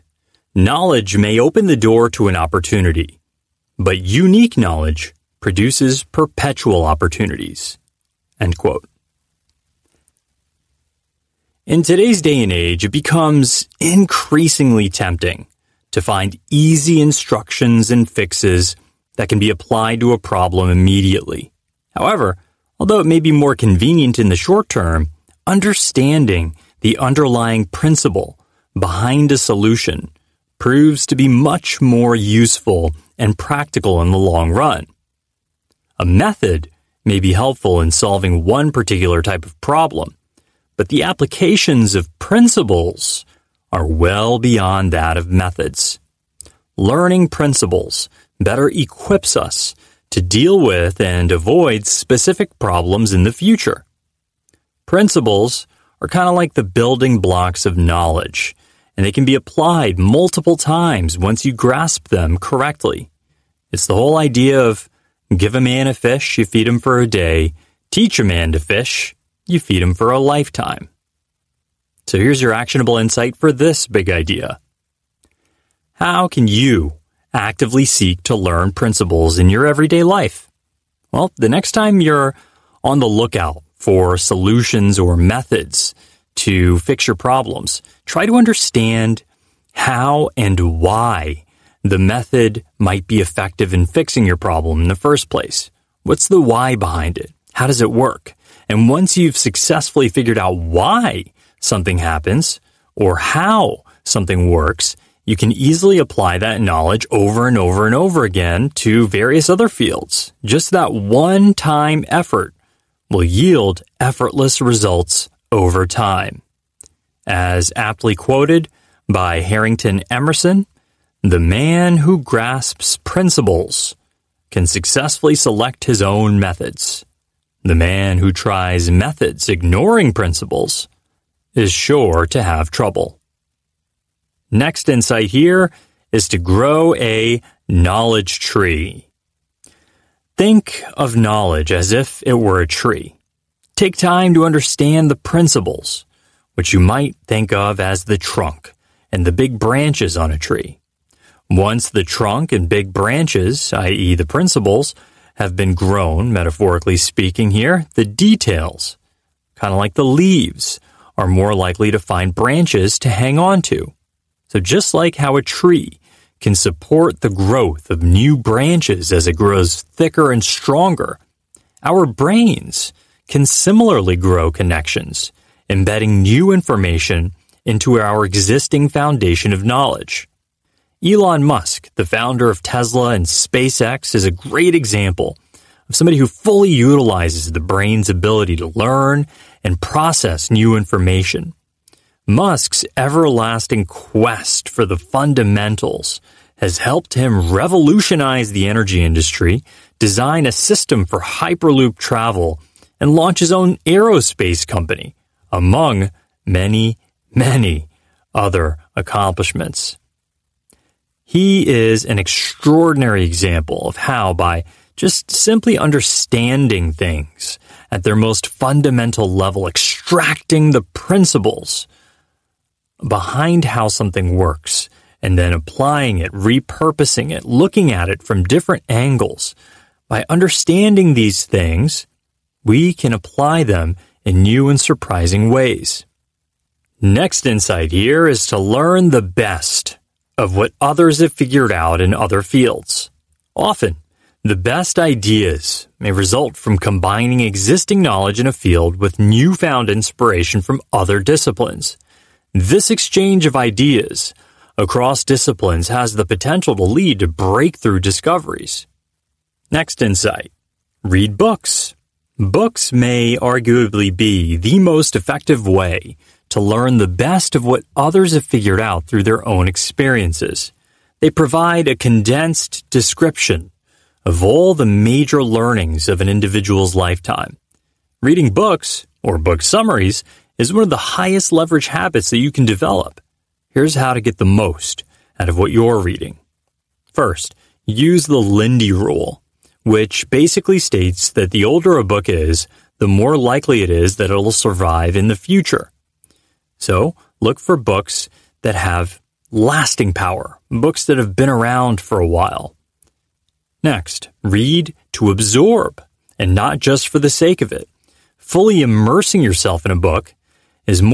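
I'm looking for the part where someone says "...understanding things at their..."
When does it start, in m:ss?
3:35.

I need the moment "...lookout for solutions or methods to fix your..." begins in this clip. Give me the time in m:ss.
1:23.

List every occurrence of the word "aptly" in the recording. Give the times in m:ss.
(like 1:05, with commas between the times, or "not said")
1:57.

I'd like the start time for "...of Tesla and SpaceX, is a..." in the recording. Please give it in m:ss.
3:02.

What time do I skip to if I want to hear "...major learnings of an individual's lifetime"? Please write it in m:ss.
4:34.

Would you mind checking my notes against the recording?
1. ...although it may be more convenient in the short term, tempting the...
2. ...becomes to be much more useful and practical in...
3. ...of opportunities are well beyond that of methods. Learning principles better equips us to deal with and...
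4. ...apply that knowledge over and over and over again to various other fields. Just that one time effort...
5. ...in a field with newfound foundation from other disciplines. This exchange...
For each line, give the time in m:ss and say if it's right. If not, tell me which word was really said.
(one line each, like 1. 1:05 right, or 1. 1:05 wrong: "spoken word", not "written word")
1. 0:22 wrong: "understanding", not "tempting"
2. 0:30 wrong: "proves", not "becomes"
3. 0:41 wrong: "principles", not "opportunities"
4. 1:45 right
5. 4:08 wrong: "inspiration", not "foundation".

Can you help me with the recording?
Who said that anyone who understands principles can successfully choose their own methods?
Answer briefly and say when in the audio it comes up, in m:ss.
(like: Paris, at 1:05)
Harrington Emerson, at 1:59.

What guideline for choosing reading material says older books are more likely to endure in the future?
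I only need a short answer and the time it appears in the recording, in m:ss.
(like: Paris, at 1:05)
Lindy rule, at 4:48.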